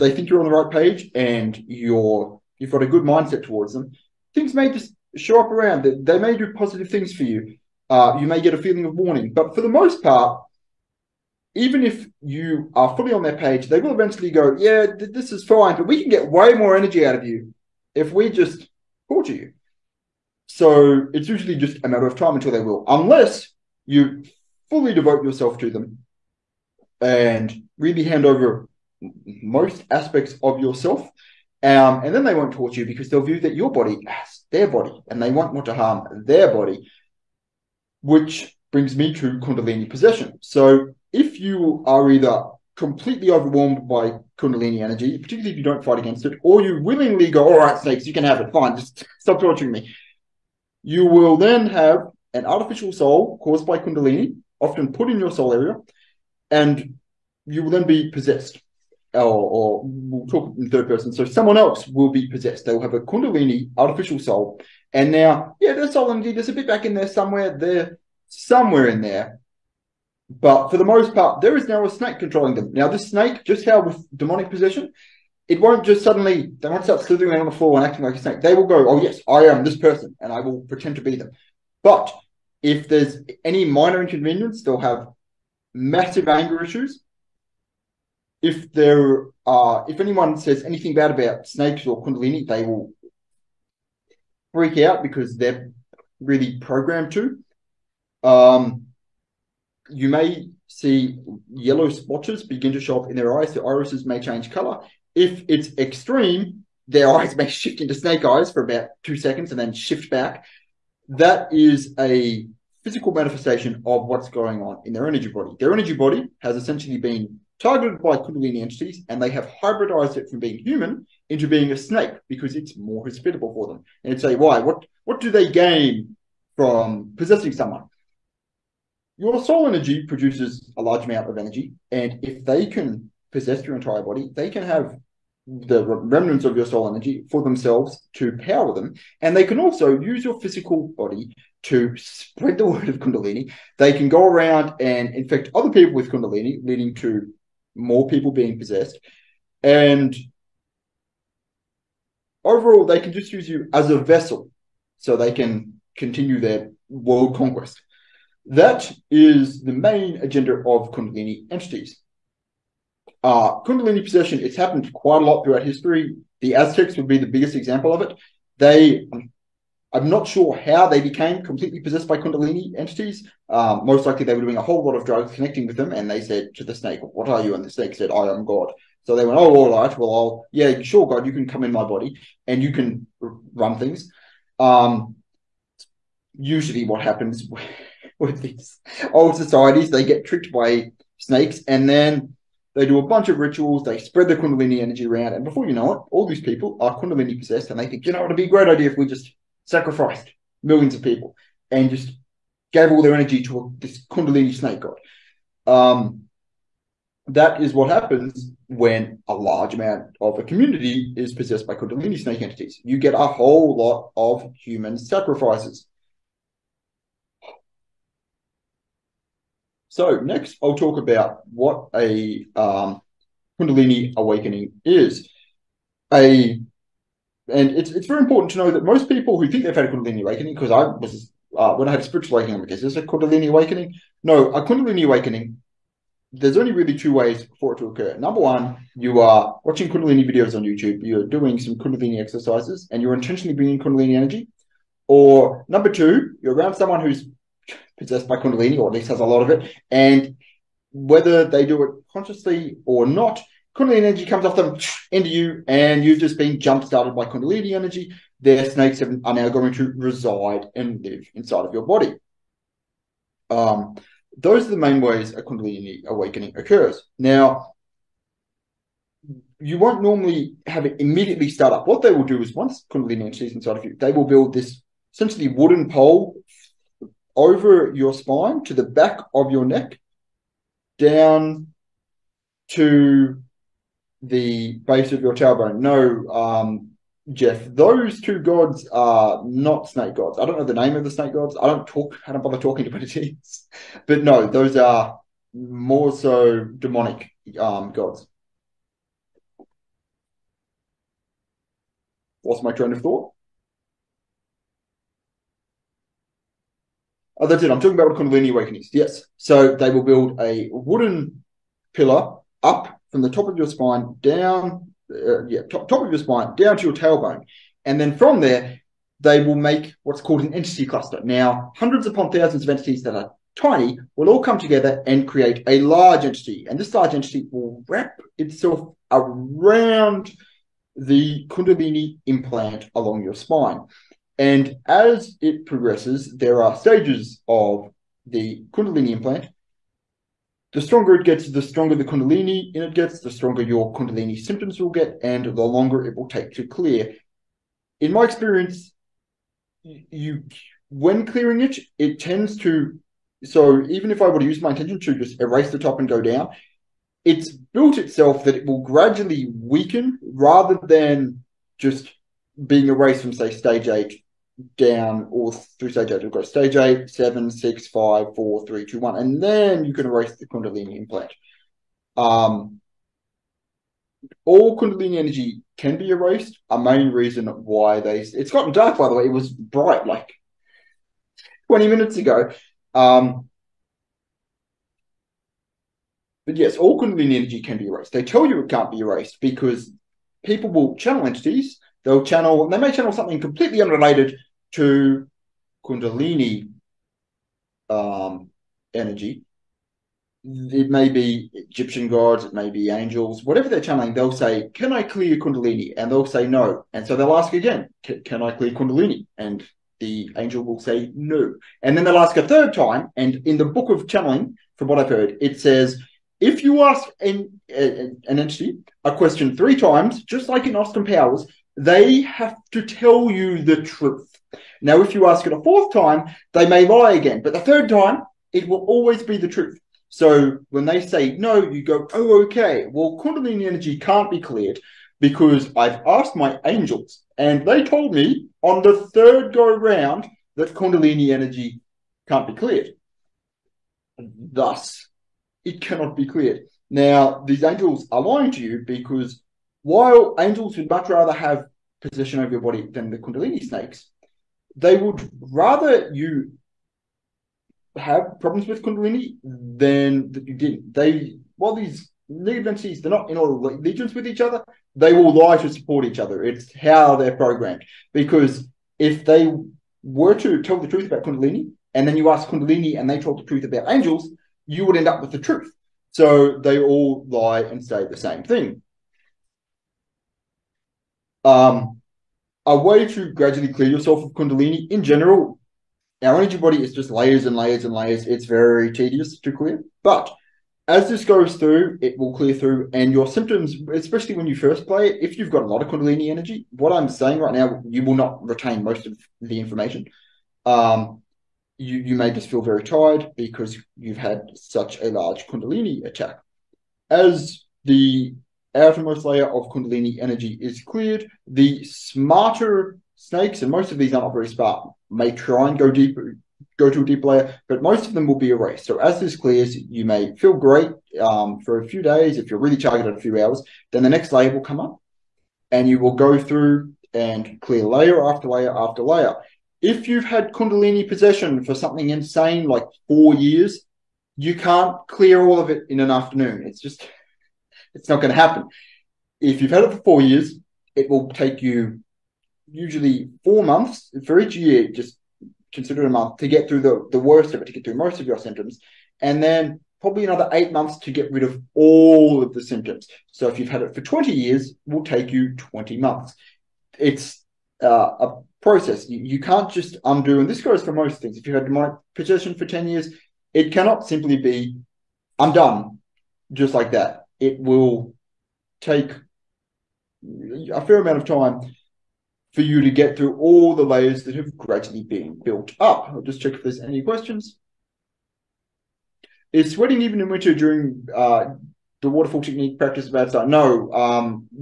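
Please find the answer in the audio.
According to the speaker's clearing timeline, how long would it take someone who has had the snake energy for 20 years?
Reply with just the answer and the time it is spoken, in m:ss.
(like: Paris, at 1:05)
20 months, at 9:15.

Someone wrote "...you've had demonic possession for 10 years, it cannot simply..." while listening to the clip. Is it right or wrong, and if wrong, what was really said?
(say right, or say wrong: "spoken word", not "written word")
right.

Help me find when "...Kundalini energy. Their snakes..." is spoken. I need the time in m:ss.
4:17.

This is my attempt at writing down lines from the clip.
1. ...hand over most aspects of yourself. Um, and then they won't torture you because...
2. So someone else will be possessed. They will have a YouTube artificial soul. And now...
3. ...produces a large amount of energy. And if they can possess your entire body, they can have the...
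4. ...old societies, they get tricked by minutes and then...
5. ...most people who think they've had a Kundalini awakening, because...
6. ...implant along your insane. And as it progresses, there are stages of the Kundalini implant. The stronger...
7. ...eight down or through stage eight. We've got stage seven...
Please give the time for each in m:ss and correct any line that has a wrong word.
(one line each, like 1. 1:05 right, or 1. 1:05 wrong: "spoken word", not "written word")
1. 0:28 right
2. 1:01 wrong: "Kundalini", not "YouTube"
3. 2:10 right
4. 3:09 wrong: "snakes", not "minutes"
5. 3:48 right
6. 5:32 wrong: "spine", not "insane"
7. 6:03 wrong: "eight", not "seven".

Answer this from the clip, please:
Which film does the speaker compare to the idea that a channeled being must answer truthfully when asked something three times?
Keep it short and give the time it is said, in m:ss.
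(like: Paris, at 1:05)
Austin Powers, at 7:00.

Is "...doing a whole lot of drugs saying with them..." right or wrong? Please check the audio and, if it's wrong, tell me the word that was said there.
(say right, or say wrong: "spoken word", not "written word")
wrong: "connecting", not "saying".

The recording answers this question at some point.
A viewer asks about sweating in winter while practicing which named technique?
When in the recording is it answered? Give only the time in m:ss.
9:42.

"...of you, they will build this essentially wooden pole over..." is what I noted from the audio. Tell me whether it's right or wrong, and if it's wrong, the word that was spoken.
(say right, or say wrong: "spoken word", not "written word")
right.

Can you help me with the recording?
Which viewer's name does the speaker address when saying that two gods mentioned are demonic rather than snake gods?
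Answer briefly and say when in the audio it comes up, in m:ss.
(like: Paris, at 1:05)
Jeff, at 4:47.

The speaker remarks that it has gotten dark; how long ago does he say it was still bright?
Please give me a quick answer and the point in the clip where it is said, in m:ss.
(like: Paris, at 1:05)
20 minutes, at 6:21.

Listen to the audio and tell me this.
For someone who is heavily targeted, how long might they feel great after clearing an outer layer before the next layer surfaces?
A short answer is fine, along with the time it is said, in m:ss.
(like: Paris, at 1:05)
a few hours, at 8:43.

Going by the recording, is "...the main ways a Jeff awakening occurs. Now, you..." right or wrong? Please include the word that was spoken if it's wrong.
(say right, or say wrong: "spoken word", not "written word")
wrong: "Kundalini", not "Jeff".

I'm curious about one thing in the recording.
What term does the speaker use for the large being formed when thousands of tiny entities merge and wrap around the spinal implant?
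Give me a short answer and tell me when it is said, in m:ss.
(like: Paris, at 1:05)
entity cluster, at 5:20.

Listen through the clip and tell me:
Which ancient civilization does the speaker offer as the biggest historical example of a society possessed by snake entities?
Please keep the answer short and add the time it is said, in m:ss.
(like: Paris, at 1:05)
Aztecs, at 2:46.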